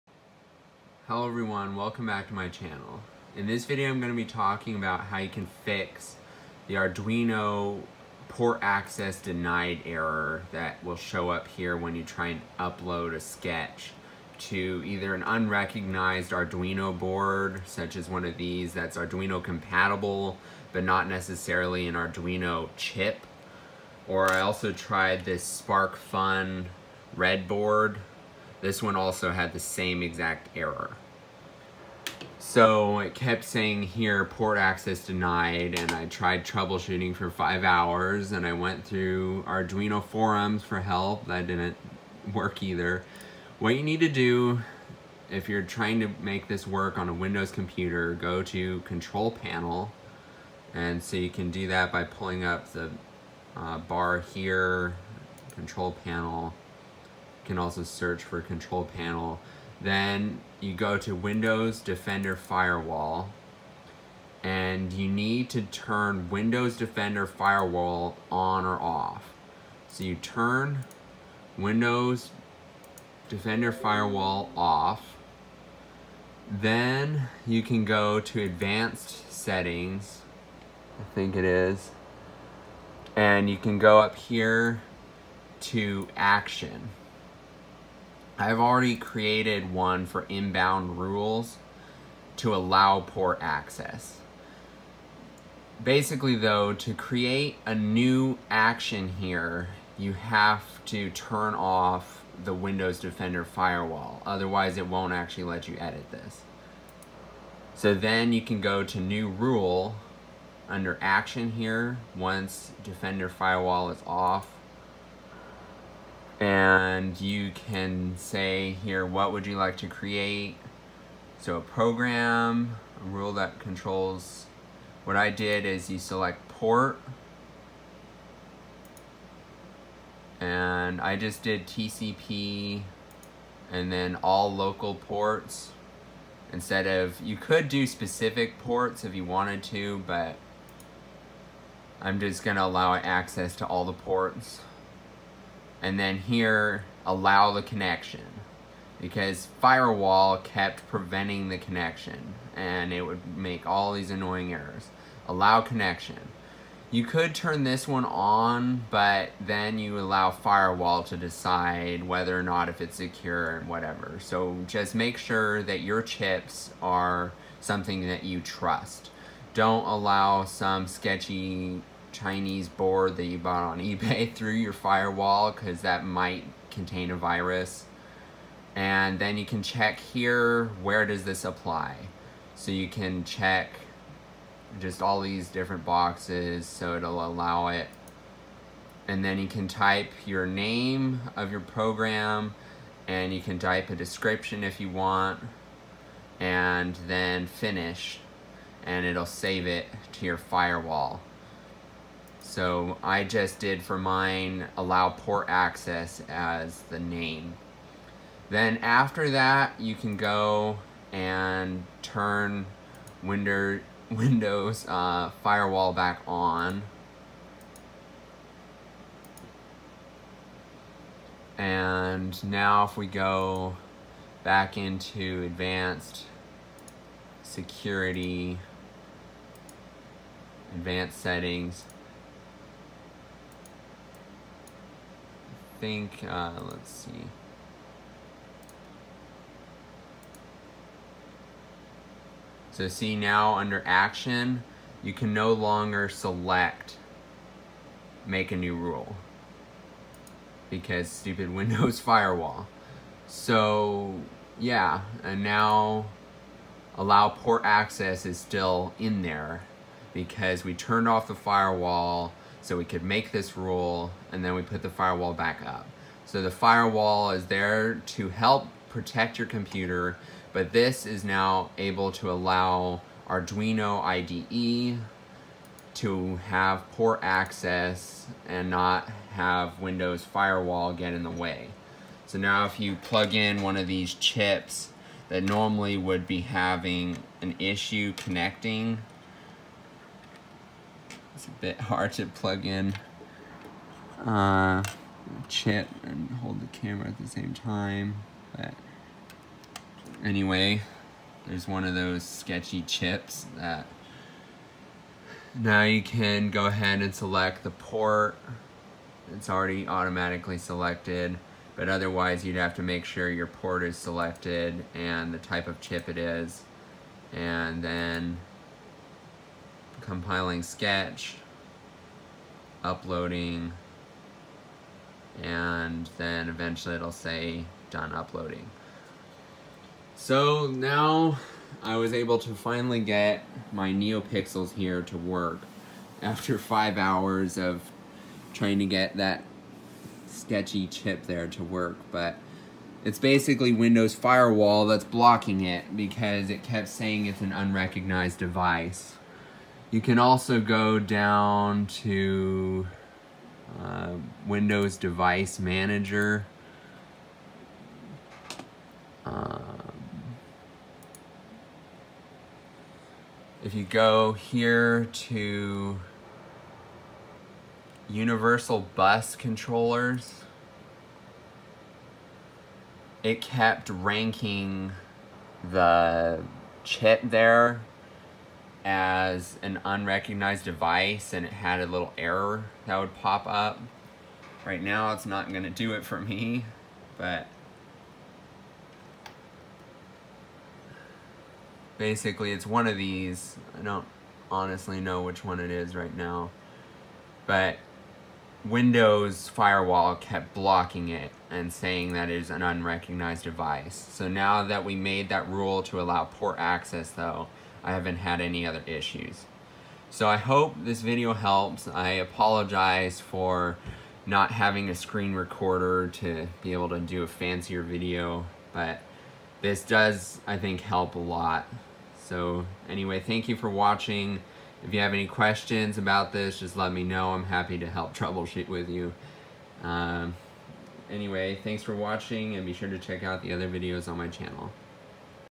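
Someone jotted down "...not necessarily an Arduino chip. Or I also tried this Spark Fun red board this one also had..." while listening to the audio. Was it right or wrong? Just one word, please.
right.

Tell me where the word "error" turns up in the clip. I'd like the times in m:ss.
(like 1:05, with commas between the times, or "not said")
0:09, 0:30, 2:34, 6:22.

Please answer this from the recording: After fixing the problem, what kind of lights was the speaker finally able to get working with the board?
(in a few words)
NeoPixels.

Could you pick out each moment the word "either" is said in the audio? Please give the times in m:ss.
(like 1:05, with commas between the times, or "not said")
0:14, 0:42.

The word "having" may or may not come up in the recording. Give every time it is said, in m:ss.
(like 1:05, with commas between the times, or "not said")
4:46, 6:54.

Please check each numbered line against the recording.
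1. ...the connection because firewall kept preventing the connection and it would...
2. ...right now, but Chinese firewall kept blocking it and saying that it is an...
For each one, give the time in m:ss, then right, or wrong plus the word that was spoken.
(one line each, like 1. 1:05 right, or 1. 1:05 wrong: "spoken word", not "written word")
1. 2:27 right
2. 6:35 wrong: "Windows", not "Chinese".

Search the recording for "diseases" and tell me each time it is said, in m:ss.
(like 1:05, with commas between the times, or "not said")
not said.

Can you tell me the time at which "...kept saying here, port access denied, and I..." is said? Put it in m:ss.
0:33.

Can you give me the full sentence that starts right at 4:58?
But anyway, there's one of those sketchy chips that now you can go ahead and select the port.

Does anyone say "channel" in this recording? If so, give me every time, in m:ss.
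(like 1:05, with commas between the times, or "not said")
0:02, 7:14.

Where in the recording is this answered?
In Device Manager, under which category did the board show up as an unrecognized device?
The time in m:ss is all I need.
6:08.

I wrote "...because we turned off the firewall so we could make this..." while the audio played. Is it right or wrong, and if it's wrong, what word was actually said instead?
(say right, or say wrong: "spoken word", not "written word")
right.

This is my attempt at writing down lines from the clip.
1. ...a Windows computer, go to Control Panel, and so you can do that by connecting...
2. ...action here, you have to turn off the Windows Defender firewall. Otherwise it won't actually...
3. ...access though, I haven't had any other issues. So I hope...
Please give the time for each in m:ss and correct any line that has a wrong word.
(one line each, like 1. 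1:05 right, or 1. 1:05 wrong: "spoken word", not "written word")
1. 0:47 wrong: "pulling", not "connecting"
2. 1:38 right
3. 6:46 right.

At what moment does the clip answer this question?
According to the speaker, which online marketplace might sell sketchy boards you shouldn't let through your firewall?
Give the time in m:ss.
2:53.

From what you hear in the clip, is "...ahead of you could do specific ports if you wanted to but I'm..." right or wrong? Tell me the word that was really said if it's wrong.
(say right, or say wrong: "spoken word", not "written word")
wrong: "instead", not "ahead".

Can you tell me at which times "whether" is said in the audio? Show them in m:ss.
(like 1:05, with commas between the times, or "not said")
2:42.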